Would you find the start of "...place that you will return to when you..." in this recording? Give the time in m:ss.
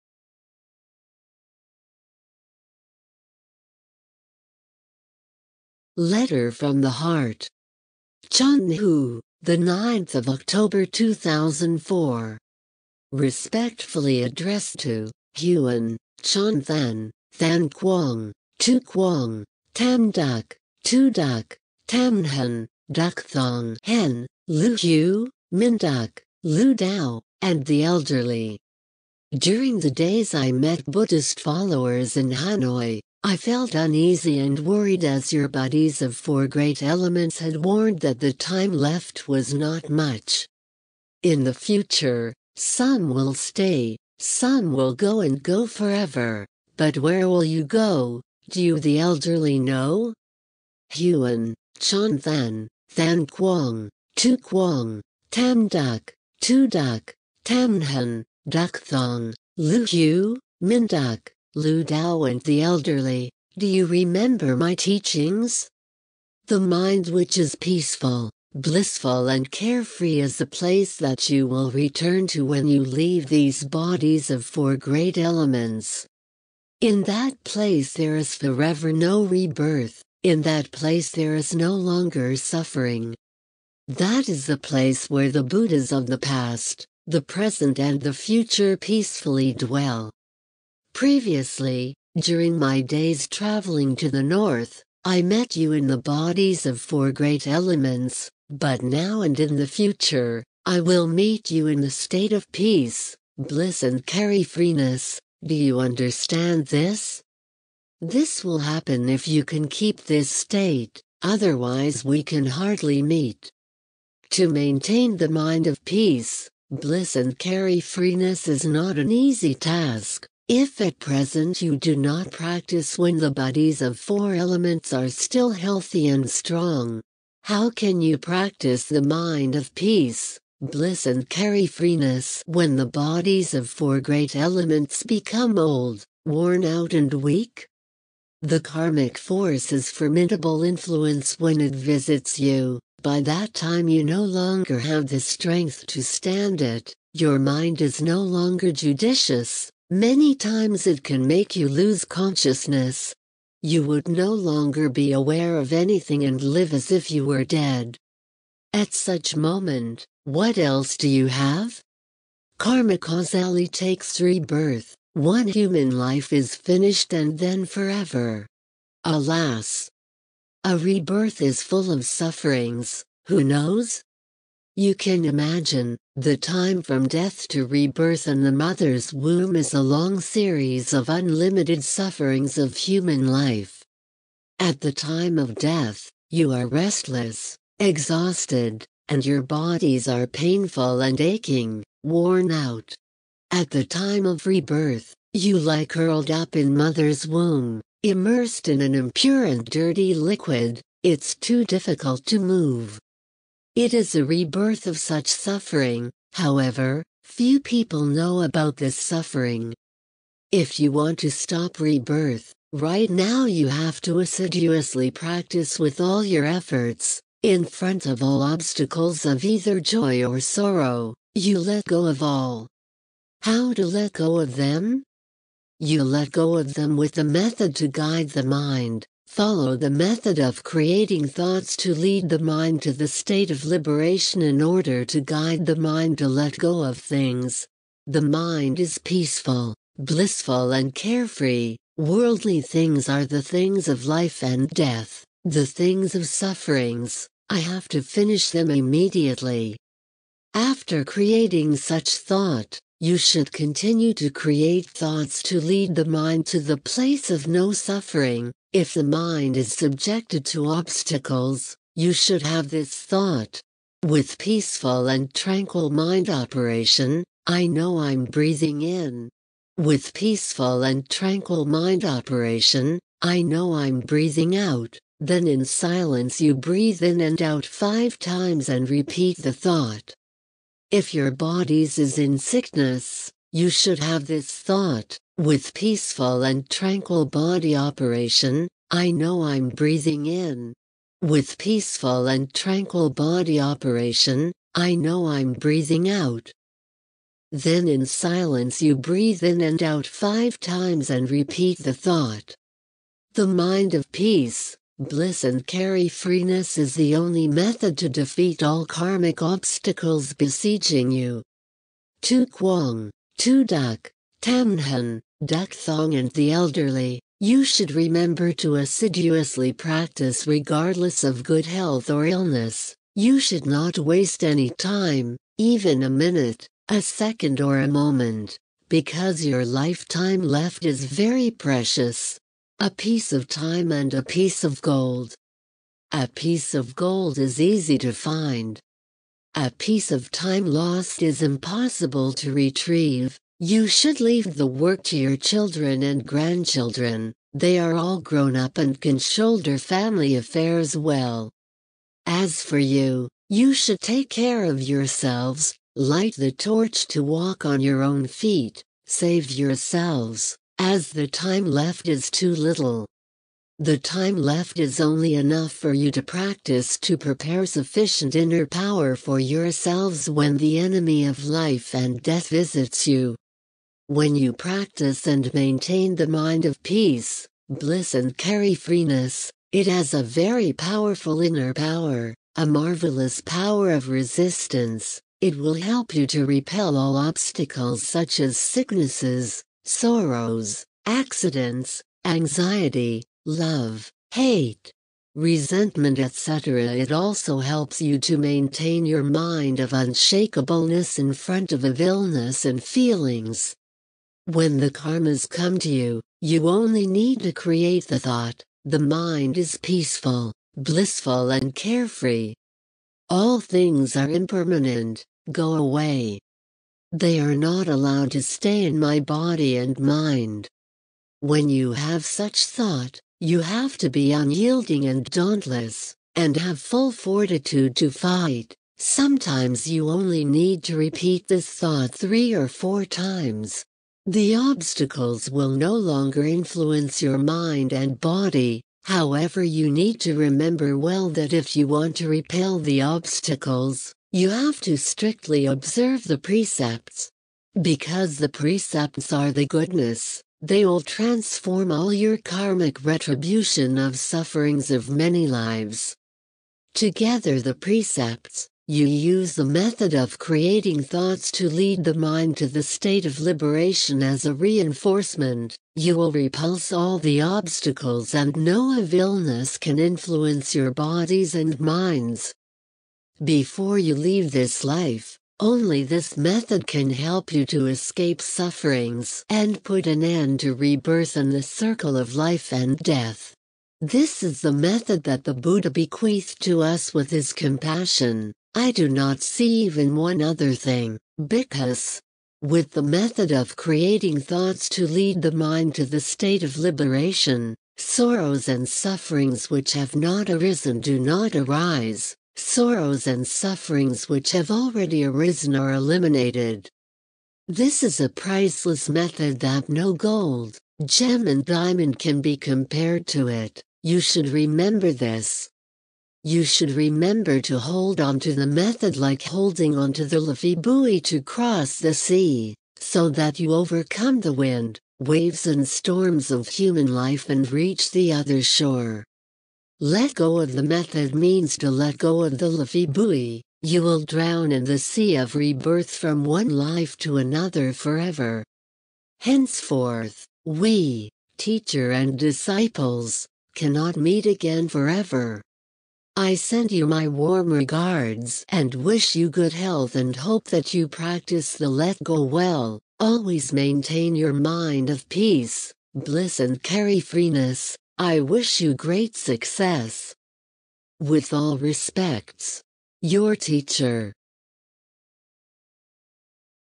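1:10.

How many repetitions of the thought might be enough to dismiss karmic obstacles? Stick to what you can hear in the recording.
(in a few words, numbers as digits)
3 or 4.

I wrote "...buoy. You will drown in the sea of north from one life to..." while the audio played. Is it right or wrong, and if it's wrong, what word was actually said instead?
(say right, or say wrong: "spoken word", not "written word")
wrong: "rebirth", not "north".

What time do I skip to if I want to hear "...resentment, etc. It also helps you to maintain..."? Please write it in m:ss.
6:35.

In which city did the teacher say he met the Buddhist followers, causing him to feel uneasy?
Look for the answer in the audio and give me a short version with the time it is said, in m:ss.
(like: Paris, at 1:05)
Hanoi, at 0:32.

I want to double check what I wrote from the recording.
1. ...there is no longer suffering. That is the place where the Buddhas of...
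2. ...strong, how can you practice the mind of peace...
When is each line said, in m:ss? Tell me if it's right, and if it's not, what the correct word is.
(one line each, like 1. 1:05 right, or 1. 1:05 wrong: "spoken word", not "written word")
1. 1:21 right
2. 2:06 right.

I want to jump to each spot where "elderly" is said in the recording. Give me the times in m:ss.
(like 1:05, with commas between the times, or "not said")
0:27, 0:48, 1:02, 5:16.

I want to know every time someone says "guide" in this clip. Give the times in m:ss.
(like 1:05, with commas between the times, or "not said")
3:47, 3:55.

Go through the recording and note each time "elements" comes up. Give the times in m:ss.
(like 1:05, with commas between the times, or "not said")
0:36, 1:15, 1:37, 2:04, 2:14.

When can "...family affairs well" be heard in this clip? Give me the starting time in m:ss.
5:49.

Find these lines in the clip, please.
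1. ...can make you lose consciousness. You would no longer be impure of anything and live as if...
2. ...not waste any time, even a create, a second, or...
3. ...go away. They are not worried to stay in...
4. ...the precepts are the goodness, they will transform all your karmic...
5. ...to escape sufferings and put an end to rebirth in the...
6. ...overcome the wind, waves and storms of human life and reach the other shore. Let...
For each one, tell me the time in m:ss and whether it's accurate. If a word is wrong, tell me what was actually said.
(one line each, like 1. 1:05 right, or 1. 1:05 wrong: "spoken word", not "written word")
1. 2:31 wrong: "aware", not "impure"
2. 5:23 wrong: "minute", not "create"
3. 6:55 wrong: "allowed", not "worried"
4. 7:28 right
5. 7:57 right
6. 8:43 right.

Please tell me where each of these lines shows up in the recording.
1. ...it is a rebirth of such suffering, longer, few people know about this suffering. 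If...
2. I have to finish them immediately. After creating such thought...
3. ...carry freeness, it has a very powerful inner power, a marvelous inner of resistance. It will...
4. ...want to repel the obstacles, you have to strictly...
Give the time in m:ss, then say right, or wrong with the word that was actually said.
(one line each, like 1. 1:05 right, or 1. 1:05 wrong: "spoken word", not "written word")
1. 3:23 wrong: "however", not "longer"
2. 4:07 right
3. 6:18 wrong: "power", not "inner"
4. 7:21 right.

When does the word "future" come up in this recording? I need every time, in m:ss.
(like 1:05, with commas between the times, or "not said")
0:41, 1:28, 1:39.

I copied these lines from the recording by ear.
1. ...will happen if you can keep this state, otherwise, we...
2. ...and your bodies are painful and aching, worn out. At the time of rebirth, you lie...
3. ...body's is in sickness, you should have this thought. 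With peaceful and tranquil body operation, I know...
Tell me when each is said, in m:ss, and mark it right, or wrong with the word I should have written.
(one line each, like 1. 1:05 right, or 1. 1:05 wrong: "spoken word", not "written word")
1. 1:48 right
2. 3:09 right
3. 4:41 right.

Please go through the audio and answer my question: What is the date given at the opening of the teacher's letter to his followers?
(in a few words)
9th of October 2004.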